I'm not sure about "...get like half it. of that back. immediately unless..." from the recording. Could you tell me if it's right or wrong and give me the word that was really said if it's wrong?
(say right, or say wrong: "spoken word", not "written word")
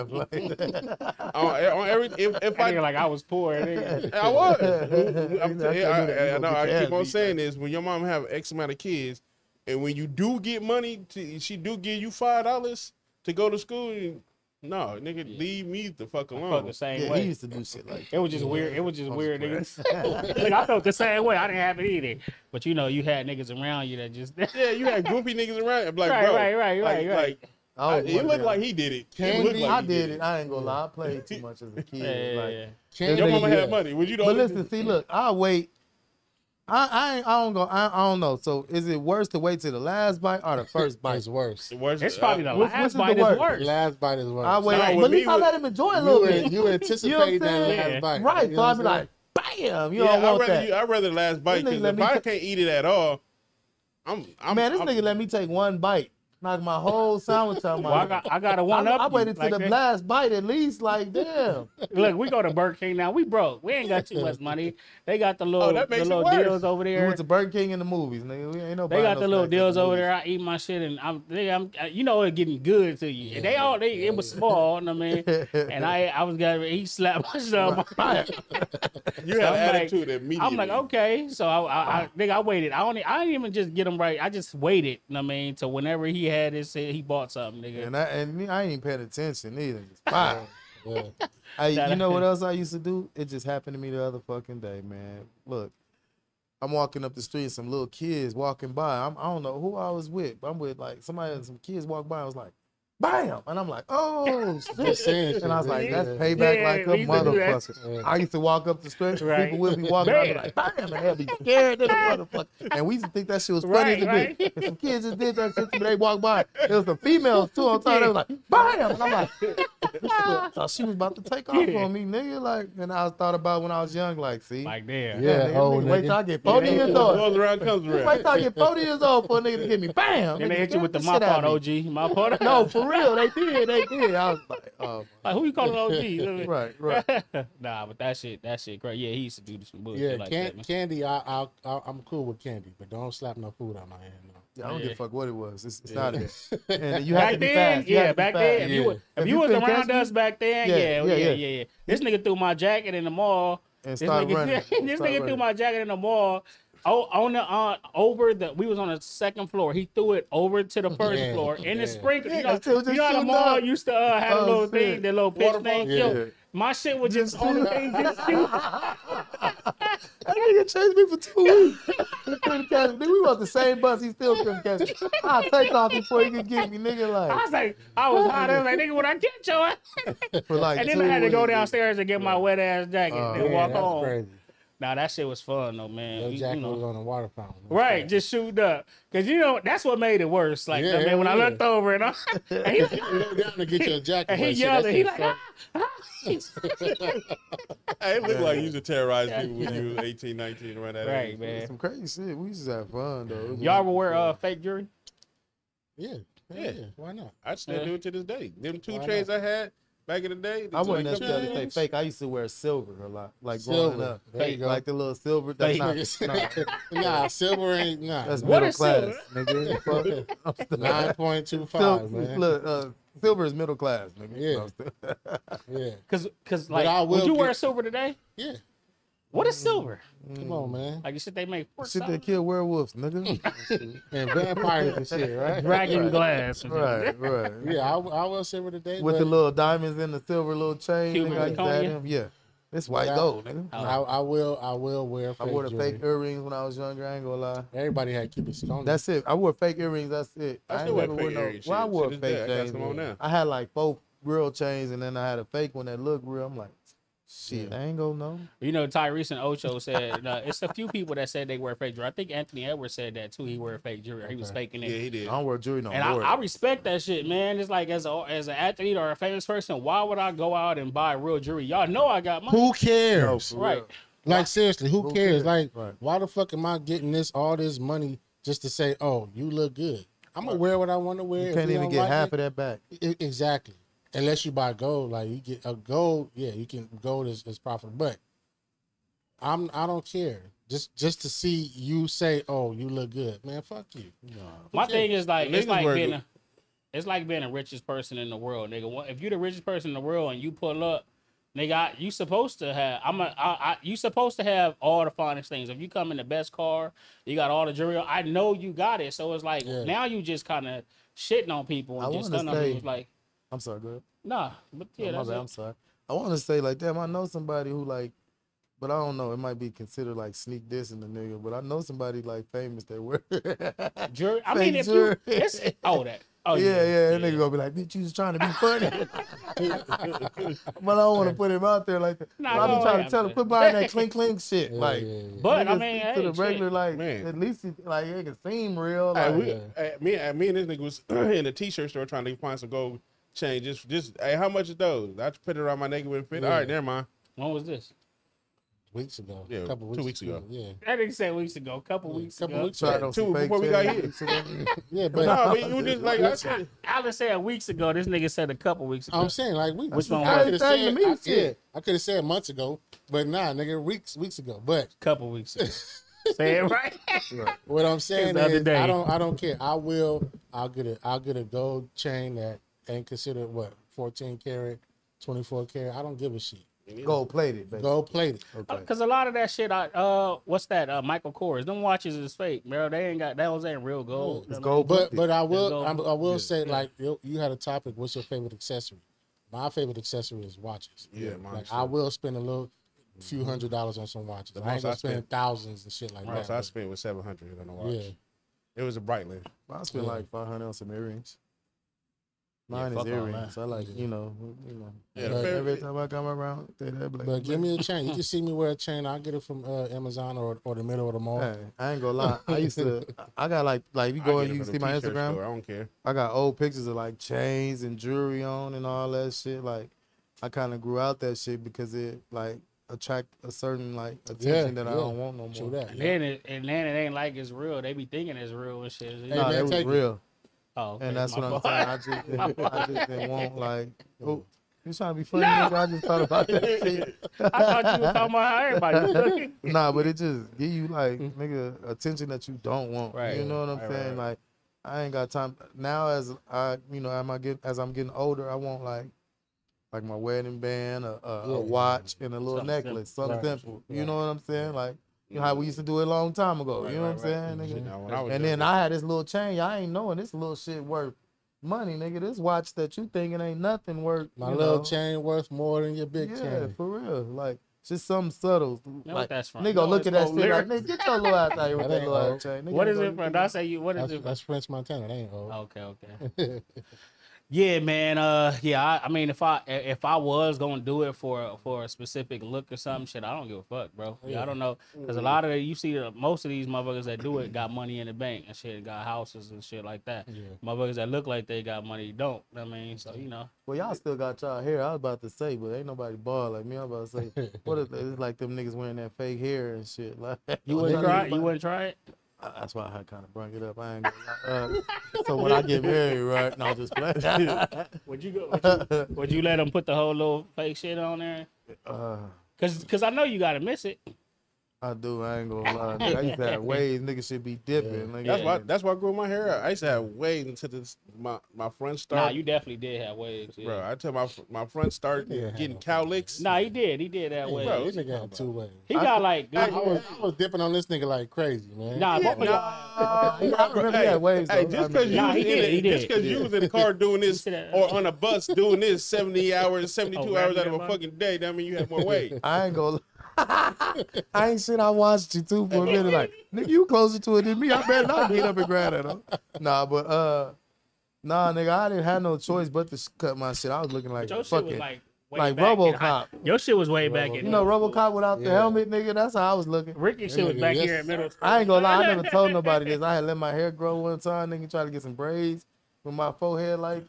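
wrong: "exactly", not "immediately".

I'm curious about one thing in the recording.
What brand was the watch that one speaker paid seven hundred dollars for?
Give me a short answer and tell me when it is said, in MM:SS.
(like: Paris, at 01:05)
Breitling, at 06:39.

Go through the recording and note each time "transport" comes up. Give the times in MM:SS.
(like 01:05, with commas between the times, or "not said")
not said.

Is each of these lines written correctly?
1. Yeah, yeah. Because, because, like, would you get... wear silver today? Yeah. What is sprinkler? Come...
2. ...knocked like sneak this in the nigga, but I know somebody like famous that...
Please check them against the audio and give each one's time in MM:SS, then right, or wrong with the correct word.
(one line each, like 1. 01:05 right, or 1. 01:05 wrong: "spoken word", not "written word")
1. 03:44 wrong: "silver", not "sprinkler"
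2. 05:19 wrong: "considered", not "knocked".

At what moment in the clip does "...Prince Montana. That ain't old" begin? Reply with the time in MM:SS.
07:54.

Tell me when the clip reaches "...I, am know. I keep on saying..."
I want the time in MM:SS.
00:05.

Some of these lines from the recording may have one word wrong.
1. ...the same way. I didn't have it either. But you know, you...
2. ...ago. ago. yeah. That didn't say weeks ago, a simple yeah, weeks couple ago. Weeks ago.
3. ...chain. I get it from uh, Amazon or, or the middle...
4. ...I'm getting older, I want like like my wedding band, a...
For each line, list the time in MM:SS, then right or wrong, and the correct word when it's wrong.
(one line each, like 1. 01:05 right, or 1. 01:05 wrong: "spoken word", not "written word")
1. 00:20 right
2. 05:50 wrong: "couple", not "simple"
3. 06:48 right
4. 07:27 right.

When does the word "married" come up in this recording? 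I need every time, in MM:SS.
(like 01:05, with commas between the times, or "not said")
08:25.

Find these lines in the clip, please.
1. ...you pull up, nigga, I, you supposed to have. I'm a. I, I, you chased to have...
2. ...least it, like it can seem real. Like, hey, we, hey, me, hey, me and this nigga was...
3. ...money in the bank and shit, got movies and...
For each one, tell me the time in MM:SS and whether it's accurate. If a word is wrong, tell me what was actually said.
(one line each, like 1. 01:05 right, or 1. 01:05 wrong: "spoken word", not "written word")
1. 05:00 wrong: "supposed", not "chased"
2. 05:37 right
3. 08:07 wrong: "houses", not "movies".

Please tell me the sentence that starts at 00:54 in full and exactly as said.
This I'm, nigga let me take one bite knocked my whole sandwich out my.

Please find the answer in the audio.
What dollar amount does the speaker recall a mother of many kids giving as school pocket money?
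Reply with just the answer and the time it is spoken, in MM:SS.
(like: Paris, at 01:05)
5 dollars, at 00:12.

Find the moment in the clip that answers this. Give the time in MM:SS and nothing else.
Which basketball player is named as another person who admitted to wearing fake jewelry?
04:22.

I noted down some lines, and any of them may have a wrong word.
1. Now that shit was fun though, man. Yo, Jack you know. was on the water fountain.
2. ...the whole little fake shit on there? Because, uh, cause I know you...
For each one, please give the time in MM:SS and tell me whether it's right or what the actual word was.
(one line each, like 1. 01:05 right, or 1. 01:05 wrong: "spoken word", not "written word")
1. 03:04 right
2. 08:29 right.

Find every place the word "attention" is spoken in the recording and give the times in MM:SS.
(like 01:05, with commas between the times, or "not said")
01:29, 07:04, 07:21.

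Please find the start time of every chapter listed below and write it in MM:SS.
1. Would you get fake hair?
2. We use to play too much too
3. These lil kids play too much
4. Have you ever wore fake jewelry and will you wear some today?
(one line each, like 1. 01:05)
1. 08:13
2. 02:30
3. 01:31
4. 03:23.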